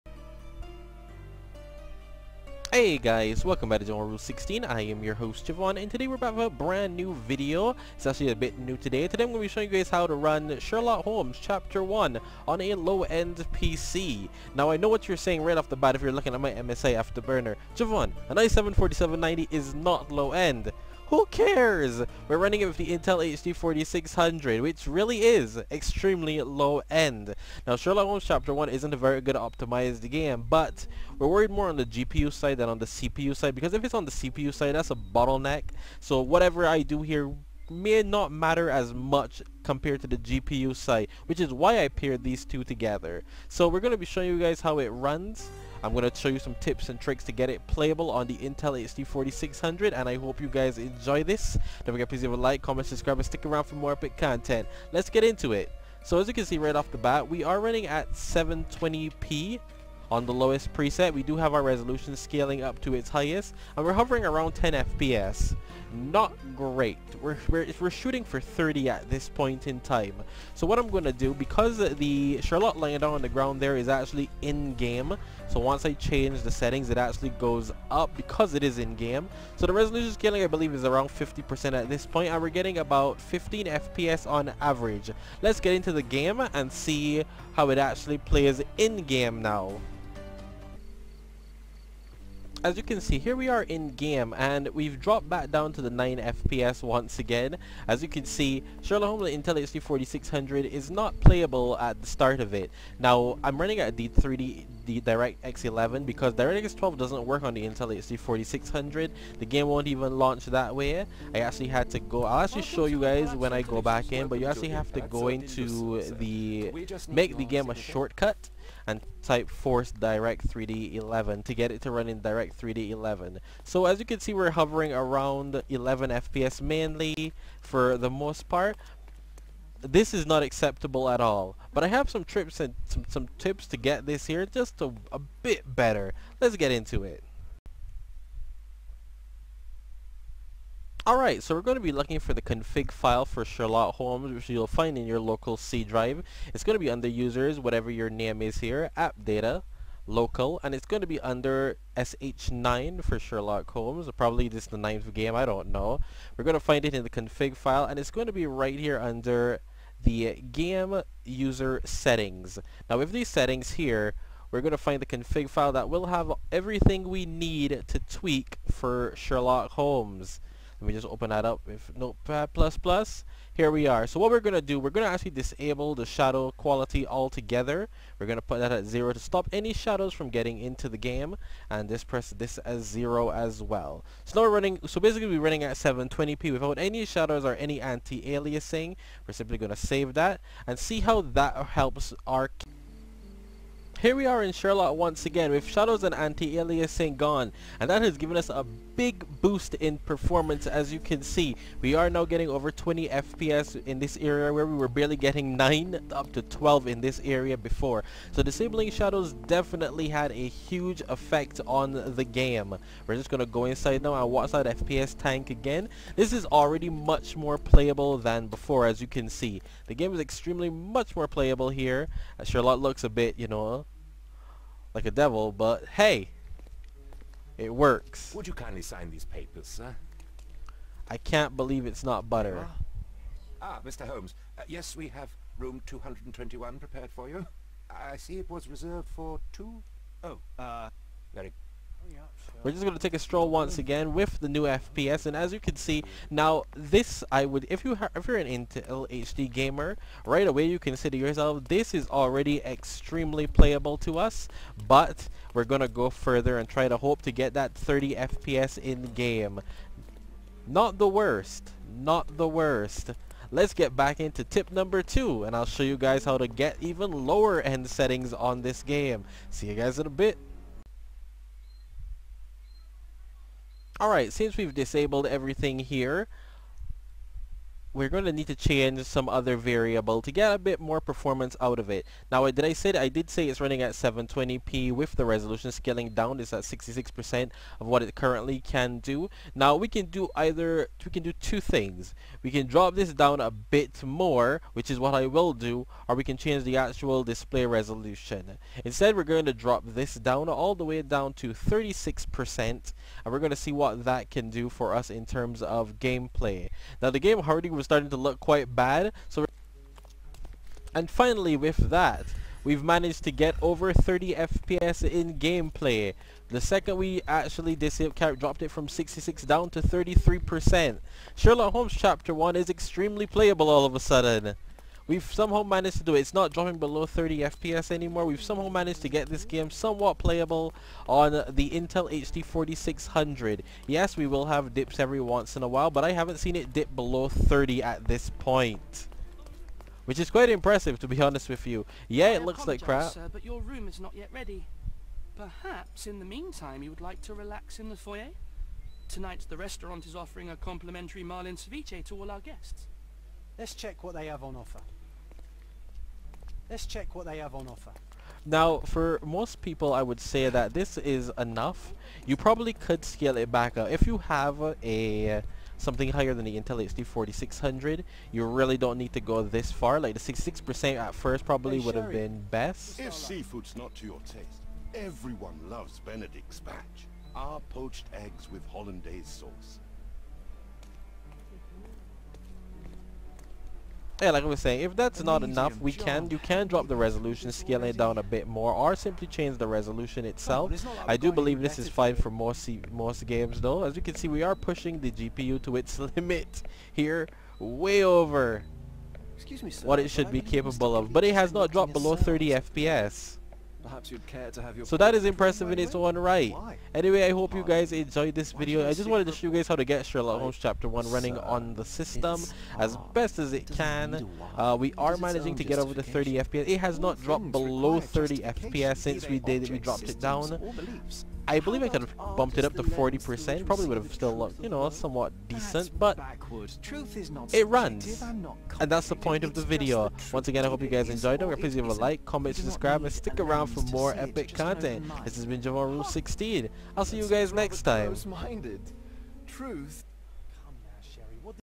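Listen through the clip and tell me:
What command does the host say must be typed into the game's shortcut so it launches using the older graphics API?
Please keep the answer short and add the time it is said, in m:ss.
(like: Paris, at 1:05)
force direct 3D 11, at 1:59.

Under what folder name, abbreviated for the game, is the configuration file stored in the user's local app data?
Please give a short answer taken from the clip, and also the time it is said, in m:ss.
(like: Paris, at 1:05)
SH9, at 2:31.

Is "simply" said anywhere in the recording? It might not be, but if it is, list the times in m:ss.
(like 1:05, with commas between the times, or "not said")
3:09, 6:28.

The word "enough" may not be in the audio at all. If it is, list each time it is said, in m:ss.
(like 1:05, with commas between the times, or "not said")
6:01, 6:25.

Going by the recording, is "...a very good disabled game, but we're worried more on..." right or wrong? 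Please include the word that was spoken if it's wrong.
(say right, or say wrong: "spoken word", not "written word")
wrong: "optimized", not "disabled".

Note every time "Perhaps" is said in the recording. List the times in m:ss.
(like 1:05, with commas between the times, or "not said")
5:45, 6:43.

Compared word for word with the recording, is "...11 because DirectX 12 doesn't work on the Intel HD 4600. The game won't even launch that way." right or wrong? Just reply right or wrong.
right.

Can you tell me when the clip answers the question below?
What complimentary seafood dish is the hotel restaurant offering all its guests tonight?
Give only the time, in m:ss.
5:51.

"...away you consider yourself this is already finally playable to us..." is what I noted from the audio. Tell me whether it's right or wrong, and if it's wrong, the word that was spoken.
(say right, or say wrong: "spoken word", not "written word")
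wrong: "extremely", not "finally".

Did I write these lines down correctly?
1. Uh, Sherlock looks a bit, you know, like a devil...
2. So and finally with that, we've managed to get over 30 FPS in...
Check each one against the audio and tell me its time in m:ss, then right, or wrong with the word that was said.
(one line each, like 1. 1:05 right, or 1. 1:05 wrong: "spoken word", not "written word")
1. 3:42 right
2. 5:09 right.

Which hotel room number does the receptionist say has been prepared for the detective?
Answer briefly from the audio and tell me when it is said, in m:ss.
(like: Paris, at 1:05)
221, at 3:55.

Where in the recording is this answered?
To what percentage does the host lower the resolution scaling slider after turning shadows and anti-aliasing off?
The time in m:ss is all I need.
5:01.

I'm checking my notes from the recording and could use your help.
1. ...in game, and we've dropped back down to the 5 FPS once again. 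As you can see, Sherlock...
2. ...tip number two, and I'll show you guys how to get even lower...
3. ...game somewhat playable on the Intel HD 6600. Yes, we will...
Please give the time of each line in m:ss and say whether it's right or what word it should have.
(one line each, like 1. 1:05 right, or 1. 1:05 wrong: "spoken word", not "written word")
1. 1:33 wrong: "9", not "5"
2. 4:24 right
3. 5:29 wrong: "4600", not "6600".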